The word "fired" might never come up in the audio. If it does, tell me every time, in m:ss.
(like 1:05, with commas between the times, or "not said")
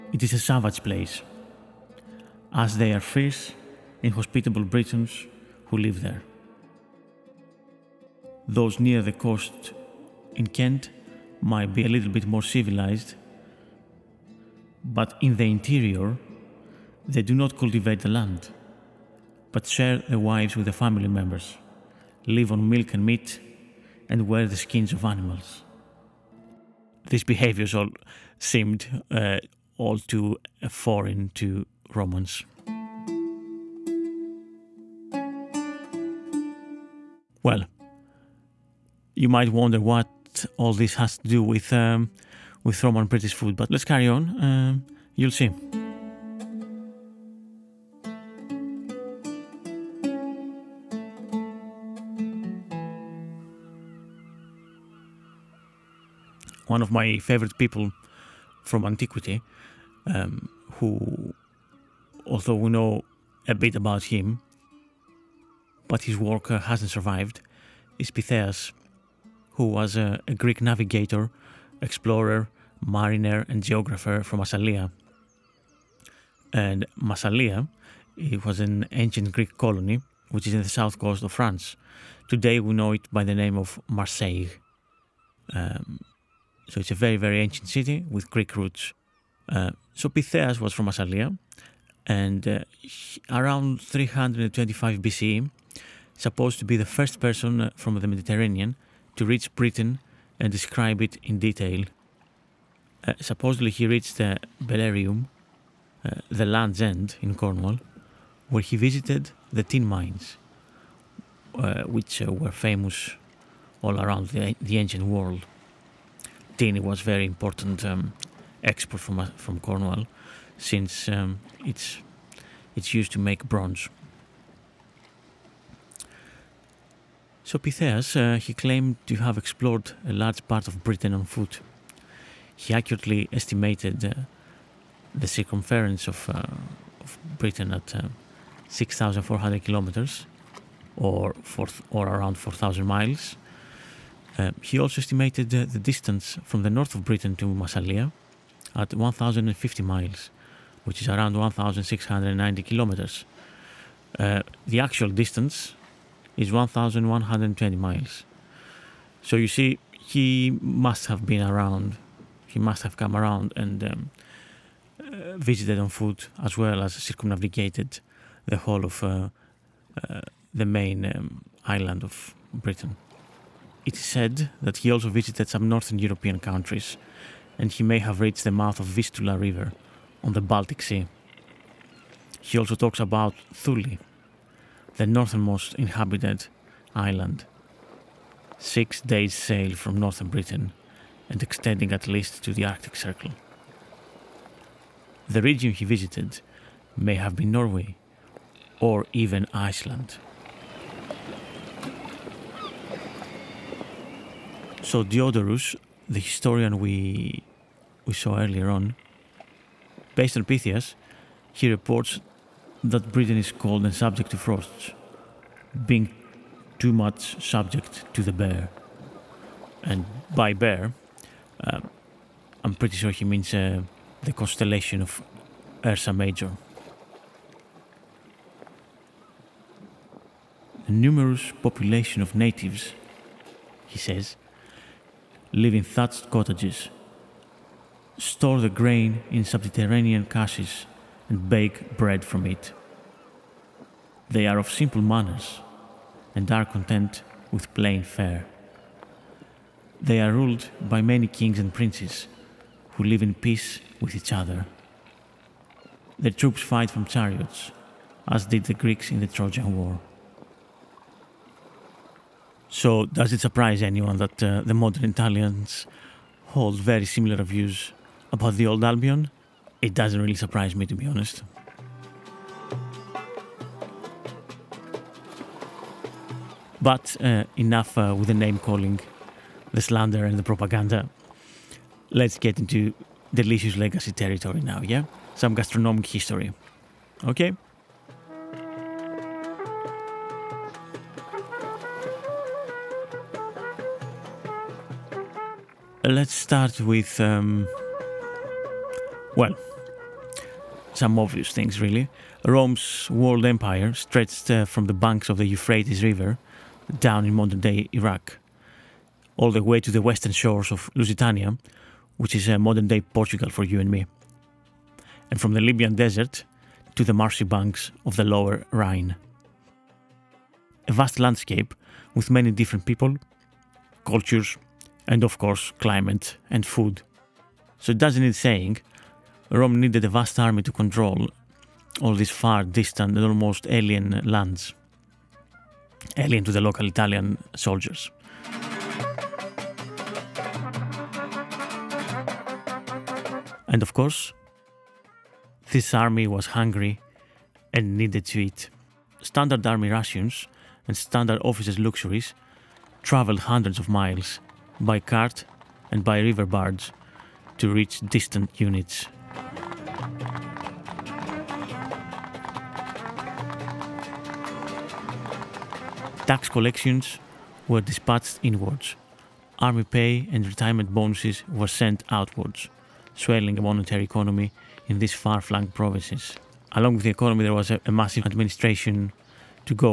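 not said.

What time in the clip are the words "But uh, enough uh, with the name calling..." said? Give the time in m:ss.
4:36.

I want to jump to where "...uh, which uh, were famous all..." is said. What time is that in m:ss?
1:51.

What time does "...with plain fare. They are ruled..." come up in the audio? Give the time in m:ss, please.
4:07.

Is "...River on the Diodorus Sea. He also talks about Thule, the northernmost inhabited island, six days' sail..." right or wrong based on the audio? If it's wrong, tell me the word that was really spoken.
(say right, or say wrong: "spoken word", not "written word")
wrong: "Baltic", not "Diodorus".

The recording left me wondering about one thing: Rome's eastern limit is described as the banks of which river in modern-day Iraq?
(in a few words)
Euphrates.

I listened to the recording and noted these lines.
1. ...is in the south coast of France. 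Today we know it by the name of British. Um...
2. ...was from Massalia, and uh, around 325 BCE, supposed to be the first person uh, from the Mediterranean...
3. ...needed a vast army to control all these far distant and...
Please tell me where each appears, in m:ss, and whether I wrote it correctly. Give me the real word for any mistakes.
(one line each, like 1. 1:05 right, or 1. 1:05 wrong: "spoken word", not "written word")
1. 1:20 wrong: "Marseille", not "British"
2. 1:30 right
3. 5:29 right.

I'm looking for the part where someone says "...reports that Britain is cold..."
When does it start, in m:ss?
3:31.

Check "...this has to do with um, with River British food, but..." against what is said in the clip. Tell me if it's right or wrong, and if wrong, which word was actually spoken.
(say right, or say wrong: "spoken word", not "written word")
wrong: "Roman", not "River".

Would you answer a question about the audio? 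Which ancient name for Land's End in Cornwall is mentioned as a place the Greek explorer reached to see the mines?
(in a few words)
Belerium.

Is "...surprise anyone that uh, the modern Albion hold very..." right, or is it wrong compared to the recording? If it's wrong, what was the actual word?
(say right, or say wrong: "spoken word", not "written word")
wrong: "Italians", not "Albion".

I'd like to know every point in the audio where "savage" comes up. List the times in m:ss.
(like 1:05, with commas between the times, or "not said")
0:00.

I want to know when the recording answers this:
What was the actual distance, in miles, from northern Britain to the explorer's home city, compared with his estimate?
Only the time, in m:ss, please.
2:36.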